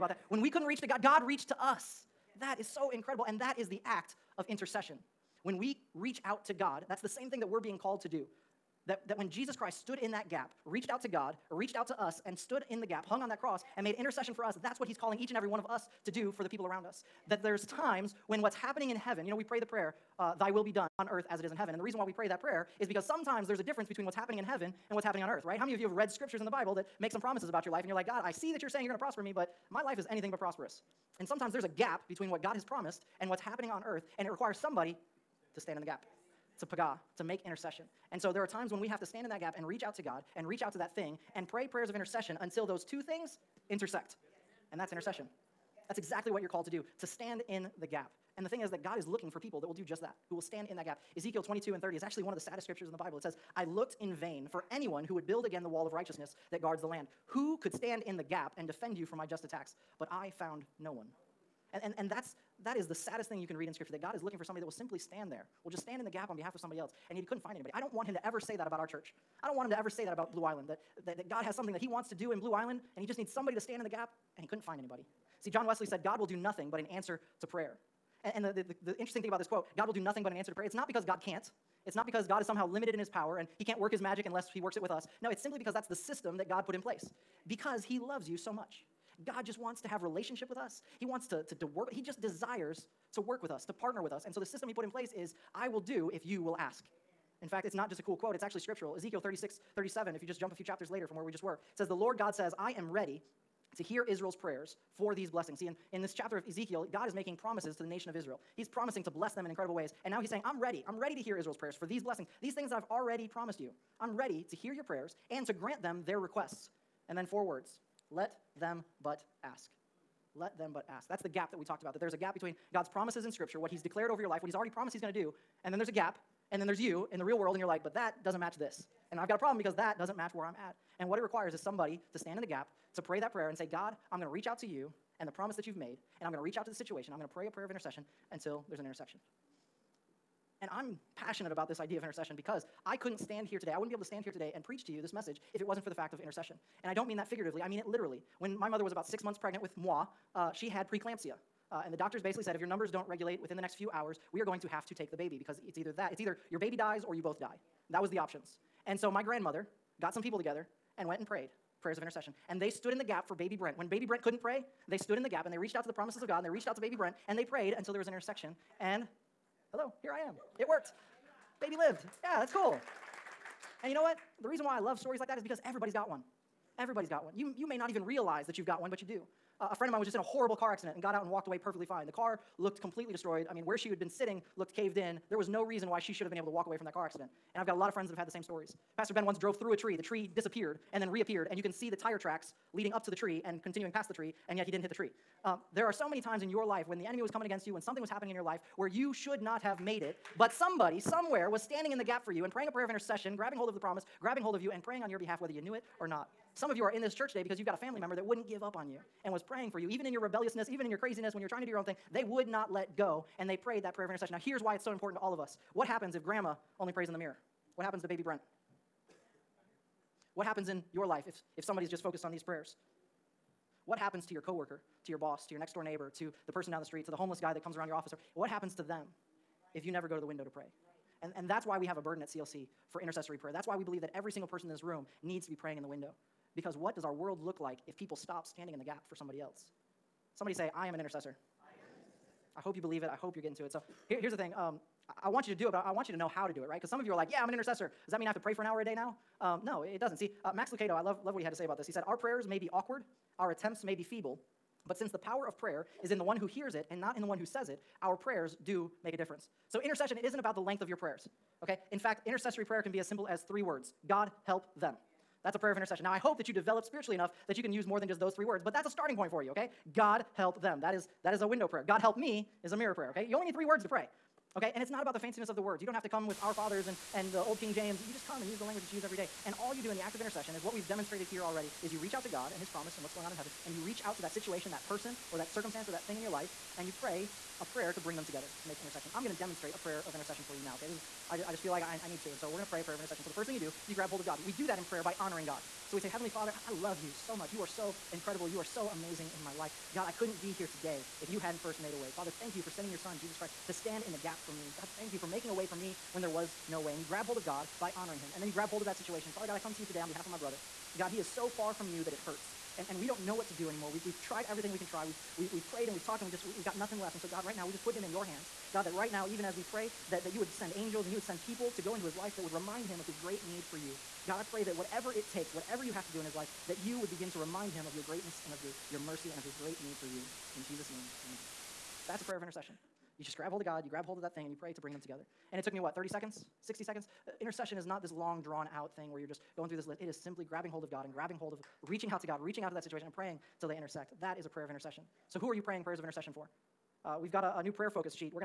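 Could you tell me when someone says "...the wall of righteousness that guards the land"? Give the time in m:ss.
0:55.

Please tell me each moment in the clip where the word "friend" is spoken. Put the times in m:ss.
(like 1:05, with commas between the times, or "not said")
2:59, 3:07.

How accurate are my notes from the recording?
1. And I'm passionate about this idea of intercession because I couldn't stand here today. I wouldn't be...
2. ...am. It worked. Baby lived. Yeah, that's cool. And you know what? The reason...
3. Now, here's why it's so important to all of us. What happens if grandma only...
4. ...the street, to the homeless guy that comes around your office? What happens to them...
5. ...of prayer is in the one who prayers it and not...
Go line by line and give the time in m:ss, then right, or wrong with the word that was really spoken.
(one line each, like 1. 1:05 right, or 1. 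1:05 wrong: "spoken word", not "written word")
1. 2:20 right
2. 2:50 right
3. 3:34 right
4. 3:46 right
5. 4:15 wrong: "hears", not "prayers".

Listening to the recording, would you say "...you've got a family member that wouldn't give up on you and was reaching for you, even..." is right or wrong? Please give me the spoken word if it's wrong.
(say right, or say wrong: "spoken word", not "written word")
wrong: "praying", not "reaching".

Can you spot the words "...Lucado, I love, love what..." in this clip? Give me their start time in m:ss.
4:10.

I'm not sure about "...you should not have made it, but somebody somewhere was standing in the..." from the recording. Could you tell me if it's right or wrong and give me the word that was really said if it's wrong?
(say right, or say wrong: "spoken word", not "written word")
right.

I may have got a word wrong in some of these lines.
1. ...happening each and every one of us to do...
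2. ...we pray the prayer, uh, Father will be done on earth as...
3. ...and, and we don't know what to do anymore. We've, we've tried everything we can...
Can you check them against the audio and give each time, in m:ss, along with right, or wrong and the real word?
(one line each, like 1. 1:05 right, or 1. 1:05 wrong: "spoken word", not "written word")
1. 0:14 wrong: "calling", not "happening"
2. 0:19 wrong: "Thy", not "Father"
3. 5:12 right.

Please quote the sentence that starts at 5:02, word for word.
Father, thank you for sending your son, Jesus Christ, to stand in the gap for me.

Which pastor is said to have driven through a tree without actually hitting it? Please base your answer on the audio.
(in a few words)
Pastor Ben.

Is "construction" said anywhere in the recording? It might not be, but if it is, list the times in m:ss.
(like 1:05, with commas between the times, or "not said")
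not said.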